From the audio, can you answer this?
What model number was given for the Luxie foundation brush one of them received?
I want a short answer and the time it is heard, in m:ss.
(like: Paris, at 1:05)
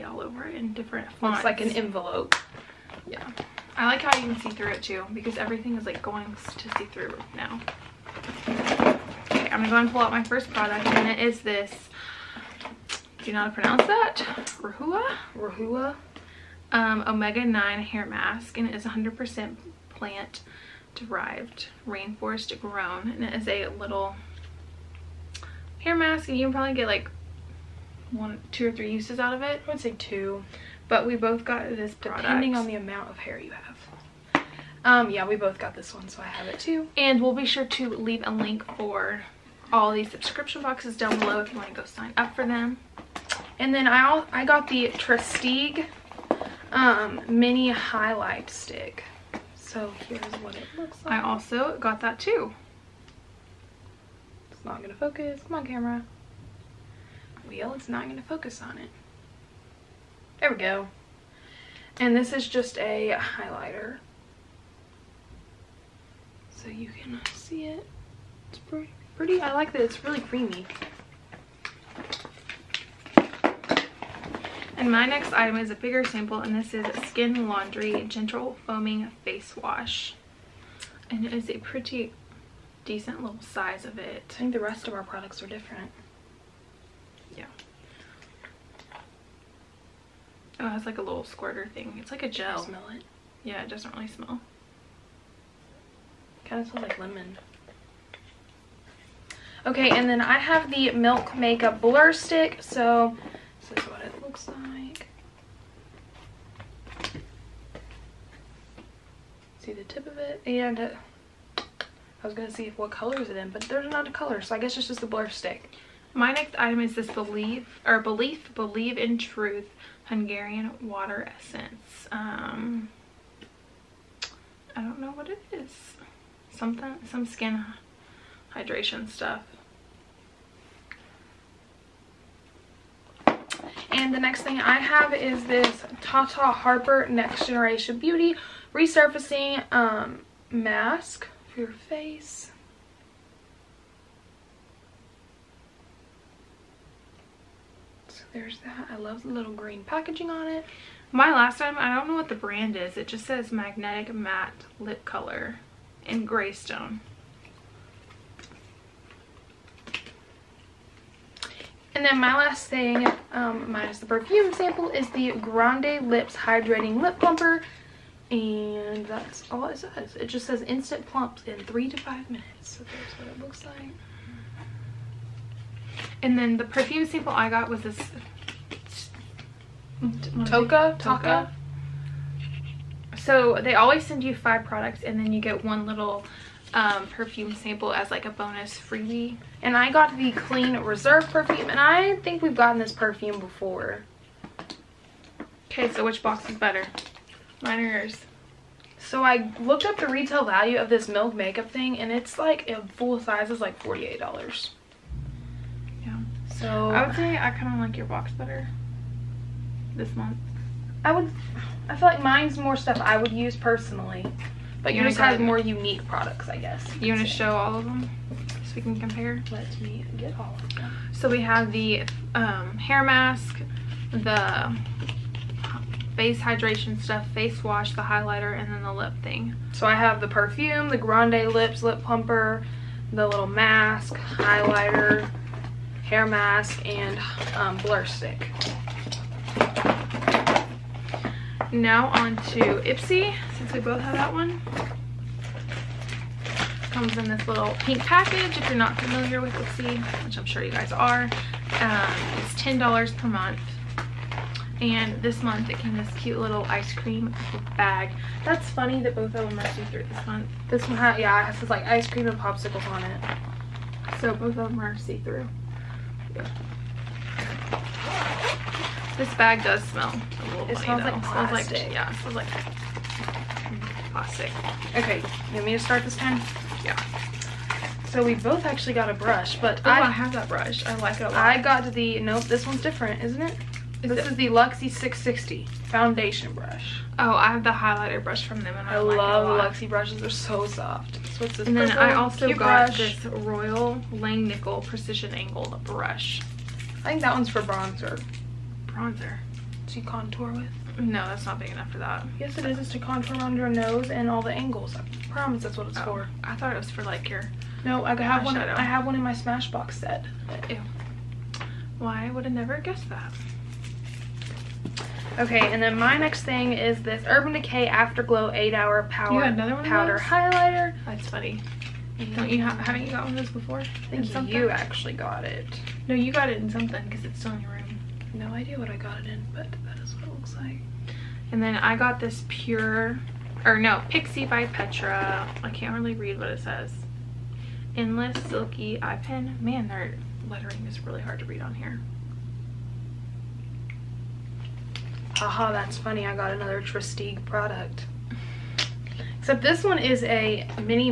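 660, at 4:44.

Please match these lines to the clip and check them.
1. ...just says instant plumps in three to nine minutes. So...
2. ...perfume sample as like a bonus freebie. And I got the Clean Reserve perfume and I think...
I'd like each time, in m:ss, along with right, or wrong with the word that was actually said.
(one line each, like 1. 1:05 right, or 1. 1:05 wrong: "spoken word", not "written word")
1. 2:50 wrong: "five", not "nine"
2. 3:07 right.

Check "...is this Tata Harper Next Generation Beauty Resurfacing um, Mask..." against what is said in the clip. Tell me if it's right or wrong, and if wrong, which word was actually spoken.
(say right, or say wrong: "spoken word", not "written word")
right.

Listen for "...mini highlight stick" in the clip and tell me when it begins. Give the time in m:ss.
0:47.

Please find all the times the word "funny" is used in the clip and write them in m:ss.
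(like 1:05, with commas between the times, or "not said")
4:18, 5:21, 5:45.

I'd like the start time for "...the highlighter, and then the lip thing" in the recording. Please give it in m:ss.
3:47.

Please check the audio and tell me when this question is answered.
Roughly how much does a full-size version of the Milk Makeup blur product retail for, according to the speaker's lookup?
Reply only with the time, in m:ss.
3:23.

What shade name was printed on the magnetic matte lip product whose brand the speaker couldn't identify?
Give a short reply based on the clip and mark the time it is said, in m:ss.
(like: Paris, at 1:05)
Greystone, at 2:36.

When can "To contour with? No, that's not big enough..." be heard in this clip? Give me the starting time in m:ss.
4:59.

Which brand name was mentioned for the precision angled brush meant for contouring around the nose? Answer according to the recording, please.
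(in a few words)
Royal Langnickel.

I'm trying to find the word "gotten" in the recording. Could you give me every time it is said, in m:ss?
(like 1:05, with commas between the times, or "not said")
3:12, 5:23.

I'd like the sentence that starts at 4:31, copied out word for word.
Smells like, yeah, it smells like plastic.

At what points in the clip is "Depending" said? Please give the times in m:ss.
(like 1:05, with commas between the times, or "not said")
0:32.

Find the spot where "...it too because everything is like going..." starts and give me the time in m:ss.
0:04.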